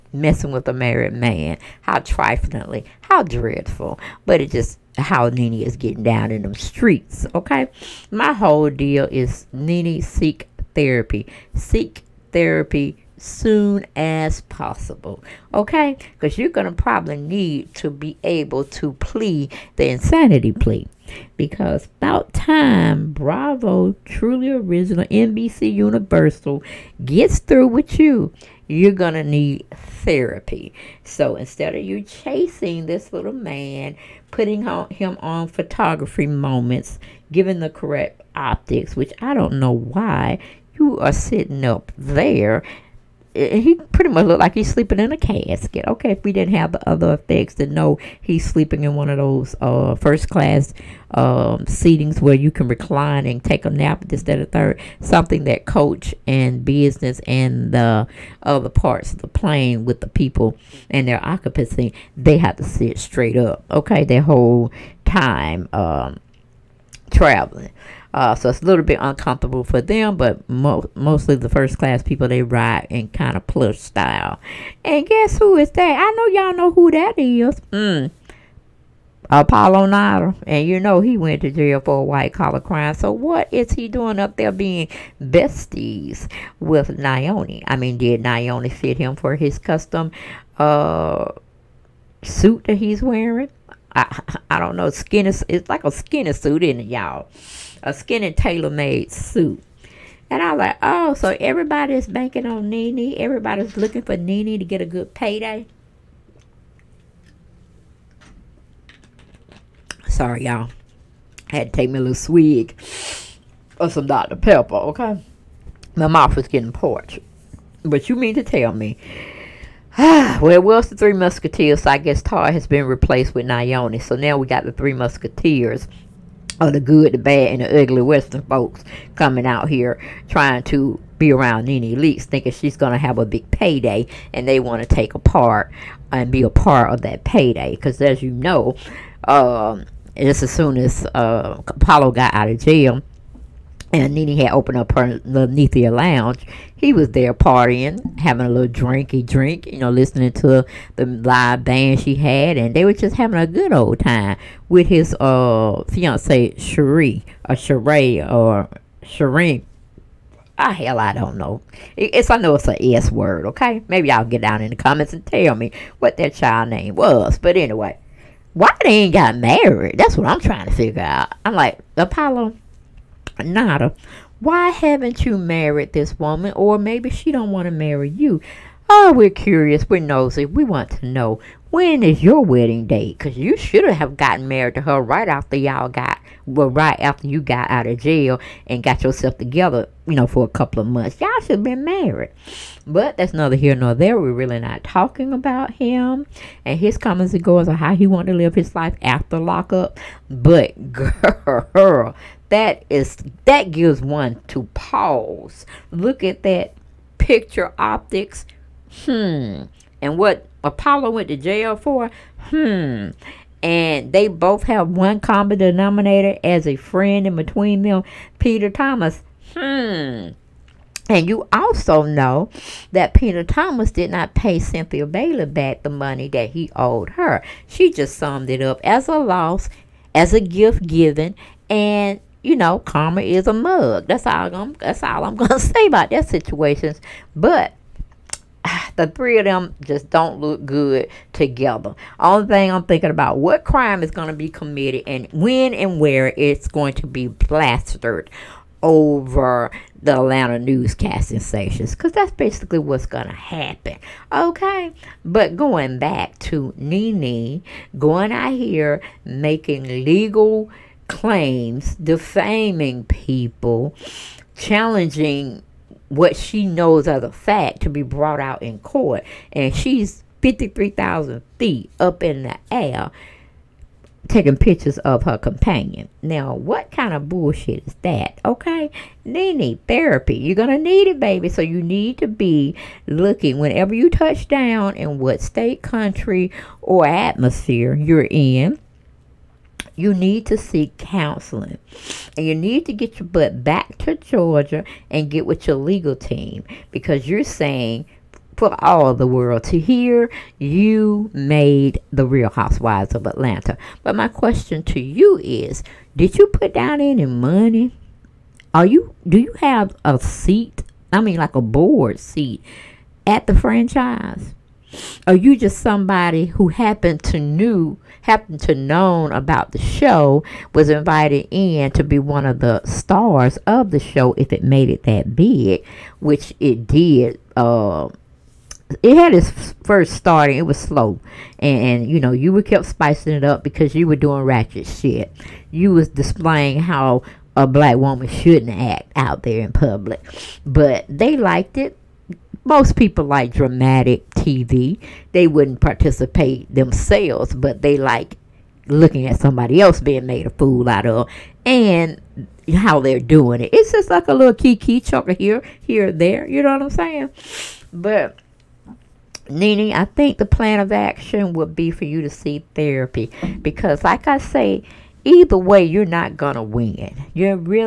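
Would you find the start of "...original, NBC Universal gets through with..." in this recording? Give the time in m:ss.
0:24.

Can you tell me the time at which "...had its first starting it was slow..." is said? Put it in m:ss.
5:29.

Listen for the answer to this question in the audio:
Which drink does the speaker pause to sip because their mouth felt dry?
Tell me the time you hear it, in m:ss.
1:54.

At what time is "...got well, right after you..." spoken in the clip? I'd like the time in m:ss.
3:05.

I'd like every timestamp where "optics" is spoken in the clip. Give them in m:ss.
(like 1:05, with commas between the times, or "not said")
0:38, 3:27.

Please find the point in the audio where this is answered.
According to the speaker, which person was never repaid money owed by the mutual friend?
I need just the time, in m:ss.
3:44.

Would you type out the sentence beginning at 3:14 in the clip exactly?
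We're really not talking about him and his comments and goals on how he wanted to live his life after lockup.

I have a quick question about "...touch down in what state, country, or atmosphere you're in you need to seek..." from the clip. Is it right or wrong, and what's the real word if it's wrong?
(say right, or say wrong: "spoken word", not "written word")
right.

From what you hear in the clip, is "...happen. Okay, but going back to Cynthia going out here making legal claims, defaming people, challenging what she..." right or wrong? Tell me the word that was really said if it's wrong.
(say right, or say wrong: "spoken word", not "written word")
wrong: "Nene", not "Cynthia".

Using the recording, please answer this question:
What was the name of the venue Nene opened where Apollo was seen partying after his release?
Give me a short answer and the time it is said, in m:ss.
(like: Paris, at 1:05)
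Linnethia Lounge, at 2:25.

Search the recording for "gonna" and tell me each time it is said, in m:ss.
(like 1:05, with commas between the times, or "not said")
0:16, 3:55.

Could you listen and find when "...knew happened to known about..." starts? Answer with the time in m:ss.
5:17.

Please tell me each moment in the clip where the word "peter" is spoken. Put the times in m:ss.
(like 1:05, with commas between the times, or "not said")
3:38, 3:43.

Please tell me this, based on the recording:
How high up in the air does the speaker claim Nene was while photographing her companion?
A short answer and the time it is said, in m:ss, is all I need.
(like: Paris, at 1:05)
53,000 feet, at 4:30.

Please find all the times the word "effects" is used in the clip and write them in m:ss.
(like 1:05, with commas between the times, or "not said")
0:47.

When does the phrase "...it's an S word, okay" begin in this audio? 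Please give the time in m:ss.
2:42.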